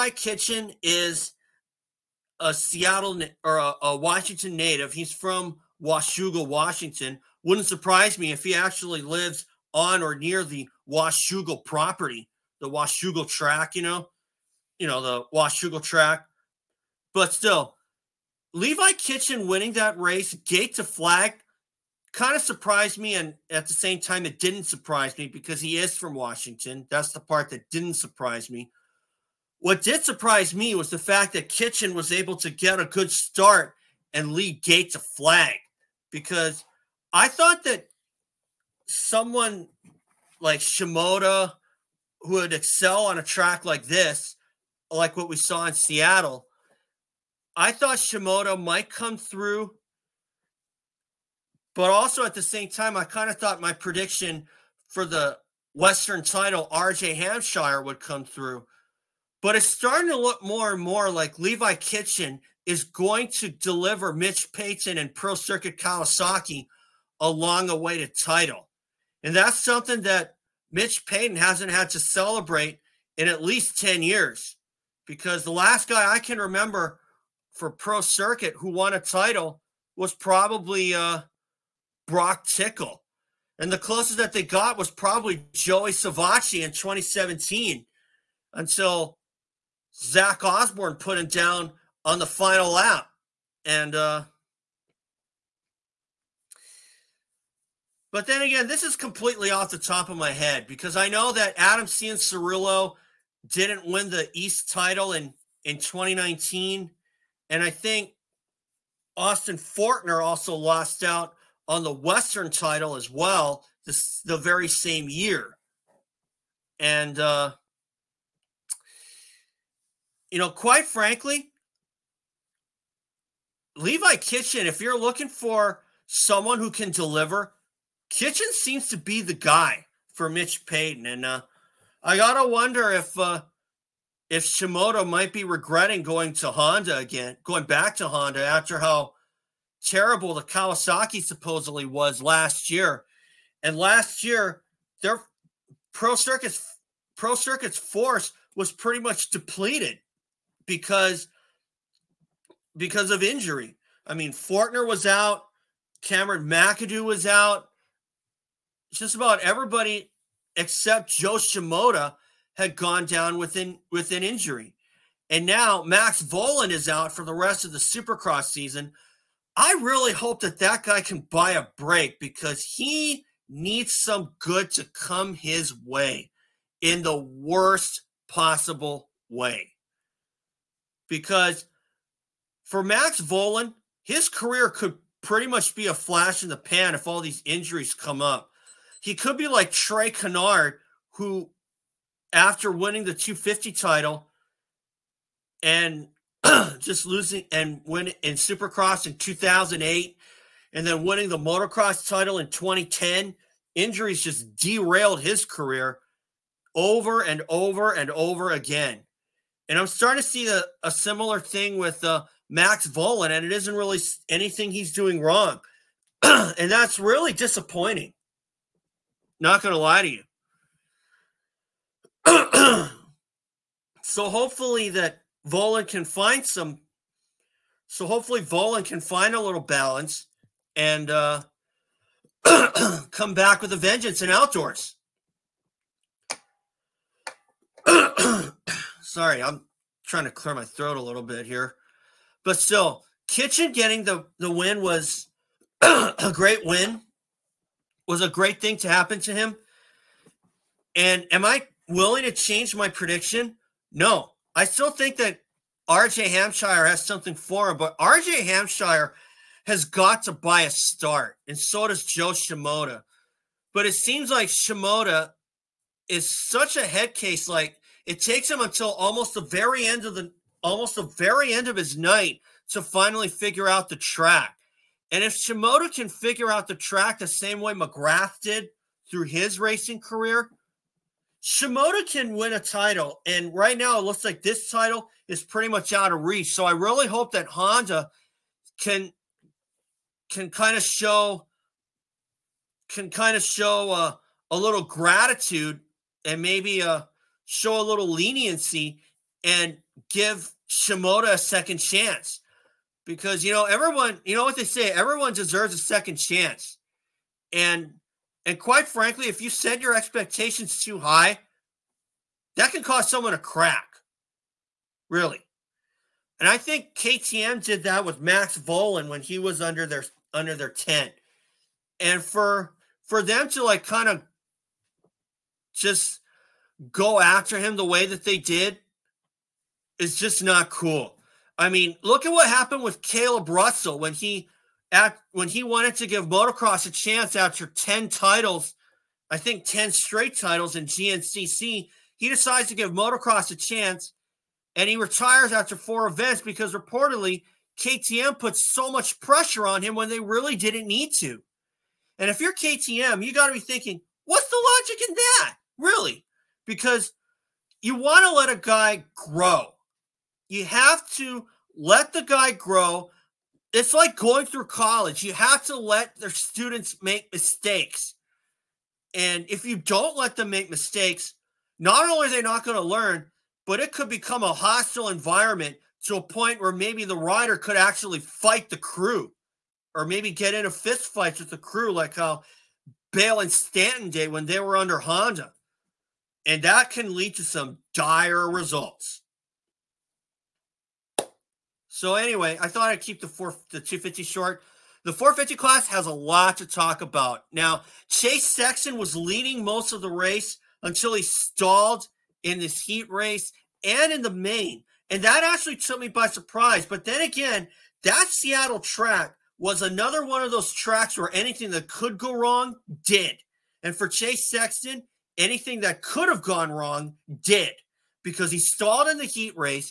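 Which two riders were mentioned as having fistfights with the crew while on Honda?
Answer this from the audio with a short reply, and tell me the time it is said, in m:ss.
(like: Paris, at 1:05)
Bale and Stanton, at 6:23.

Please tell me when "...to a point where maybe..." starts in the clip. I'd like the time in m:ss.
6:16.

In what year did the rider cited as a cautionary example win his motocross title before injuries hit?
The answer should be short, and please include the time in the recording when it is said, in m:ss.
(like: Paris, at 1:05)
2010, at 3:22.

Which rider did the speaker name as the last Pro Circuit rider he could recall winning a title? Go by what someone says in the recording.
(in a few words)
Brock Tickle.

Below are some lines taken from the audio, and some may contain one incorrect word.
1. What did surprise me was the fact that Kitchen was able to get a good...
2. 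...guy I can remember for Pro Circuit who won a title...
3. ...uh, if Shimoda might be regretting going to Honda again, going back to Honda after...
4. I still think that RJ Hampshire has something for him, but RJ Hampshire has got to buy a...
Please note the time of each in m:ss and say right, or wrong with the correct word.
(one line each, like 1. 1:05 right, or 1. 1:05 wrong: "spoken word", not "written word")
1. 0:29 right
2. 1:15 right
3. 2:13 right
4. 4:14 right.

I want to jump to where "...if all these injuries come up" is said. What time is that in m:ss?
3:06.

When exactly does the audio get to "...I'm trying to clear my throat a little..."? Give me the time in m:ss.
3:59.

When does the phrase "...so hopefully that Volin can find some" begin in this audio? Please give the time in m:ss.
3:44.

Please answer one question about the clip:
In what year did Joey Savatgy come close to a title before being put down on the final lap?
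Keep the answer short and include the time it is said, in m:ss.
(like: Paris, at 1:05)
2017, at 1:26.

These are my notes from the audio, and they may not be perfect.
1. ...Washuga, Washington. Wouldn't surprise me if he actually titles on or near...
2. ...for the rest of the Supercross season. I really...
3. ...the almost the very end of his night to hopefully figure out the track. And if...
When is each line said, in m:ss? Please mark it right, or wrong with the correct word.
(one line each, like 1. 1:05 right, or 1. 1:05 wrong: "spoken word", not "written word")
1. 0:05 wrong: "lives", not "titles"
2. 2:47 right
3. 4:30 wrong: "finally", not "hopefully".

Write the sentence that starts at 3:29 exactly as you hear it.
And I'm starting to see a, a similar thing with uh, Max Volin, and it isn't really anything he's doing wrong.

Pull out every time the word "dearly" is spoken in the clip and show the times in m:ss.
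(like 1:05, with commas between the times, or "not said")
not said.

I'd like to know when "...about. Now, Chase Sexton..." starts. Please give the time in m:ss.
6:37.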